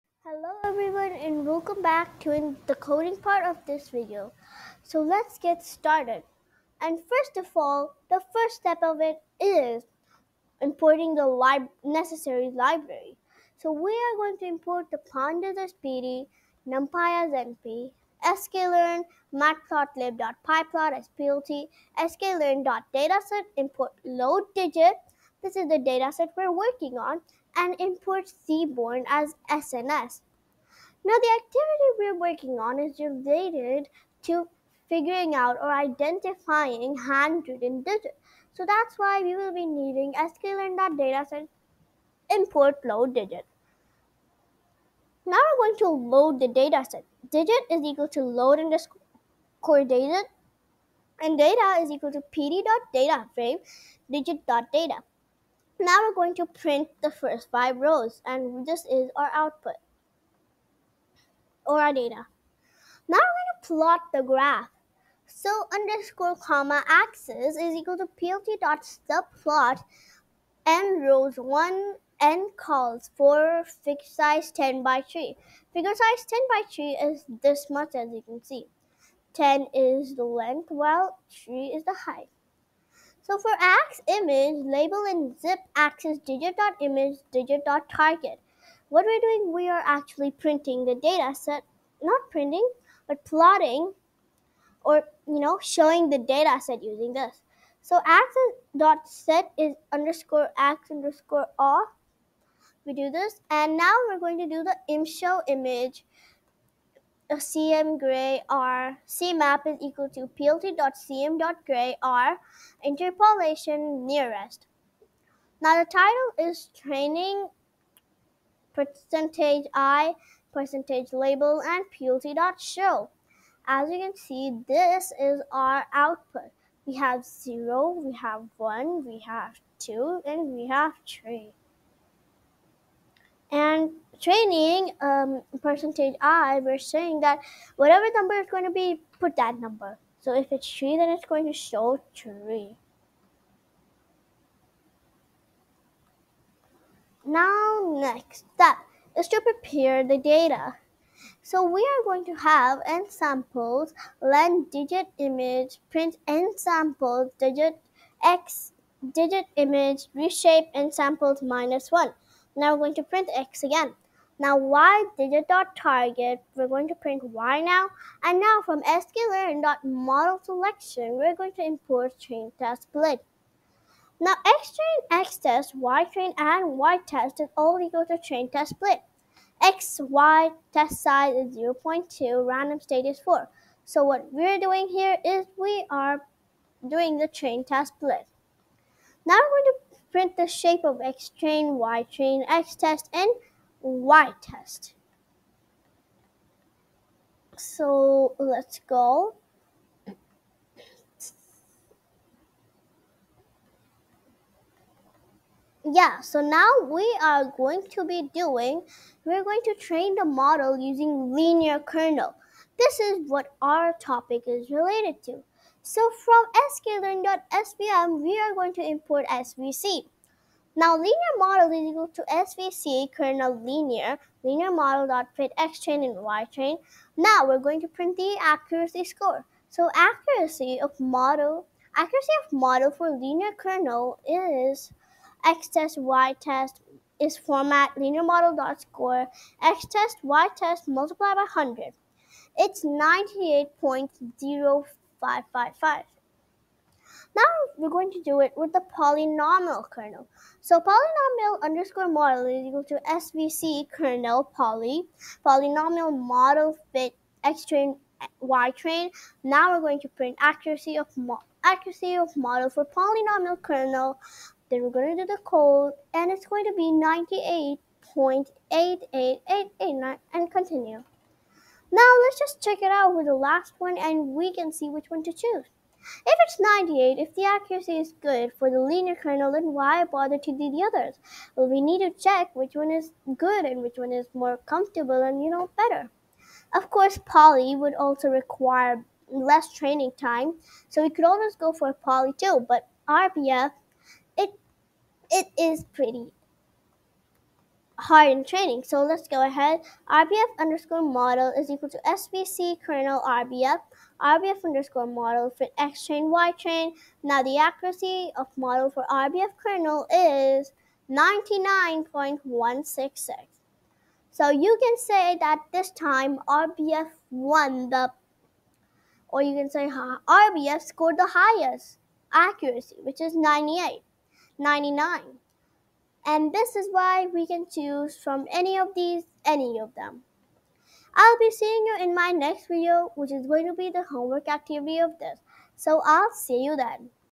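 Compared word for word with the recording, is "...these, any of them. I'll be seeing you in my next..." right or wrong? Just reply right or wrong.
right.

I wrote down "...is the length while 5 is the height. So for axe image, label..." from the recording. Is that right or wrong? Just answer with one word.
wrong.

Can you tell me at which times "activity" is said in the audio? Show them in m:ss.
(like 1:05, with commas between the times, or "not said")
0:31, 5:34.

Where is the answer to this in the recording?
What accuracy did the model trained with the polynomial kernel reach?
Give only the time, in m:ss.
4:28.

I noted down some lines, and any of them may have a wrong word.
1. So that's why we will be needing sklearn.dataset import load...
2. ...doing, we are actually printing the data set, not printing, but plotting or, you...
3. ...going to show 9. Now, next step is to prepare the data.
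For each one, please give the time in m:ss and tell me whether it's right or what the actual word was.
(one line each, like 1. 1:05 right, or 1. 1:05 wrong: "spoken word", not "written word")
1. 0:38 right
2. 1:29 right
3. 2:21 wrong: "3", not "9".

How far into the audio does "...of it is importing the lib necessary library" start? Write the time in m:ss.
0:08.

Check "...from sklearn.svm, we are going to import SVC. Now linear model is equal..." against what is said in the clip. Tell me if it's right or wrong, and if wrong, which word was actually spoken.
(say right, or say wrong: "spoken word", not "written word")
right.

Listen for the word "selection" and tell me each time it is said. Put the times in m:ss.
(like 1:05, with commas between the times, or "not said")
2:50.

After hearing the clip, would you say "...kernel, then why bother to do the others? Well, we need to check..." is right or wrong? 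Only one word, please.
right.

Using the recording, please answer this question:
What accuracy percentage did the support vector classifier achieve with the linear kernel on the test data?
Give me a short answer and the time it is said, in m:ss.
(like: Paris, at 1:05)
98.0555, at 4:02.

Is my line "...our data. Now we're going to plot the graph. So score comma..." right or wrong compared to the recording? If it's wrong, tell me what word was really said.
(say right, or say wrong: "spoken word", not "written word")
wrong: "underscore", not "score".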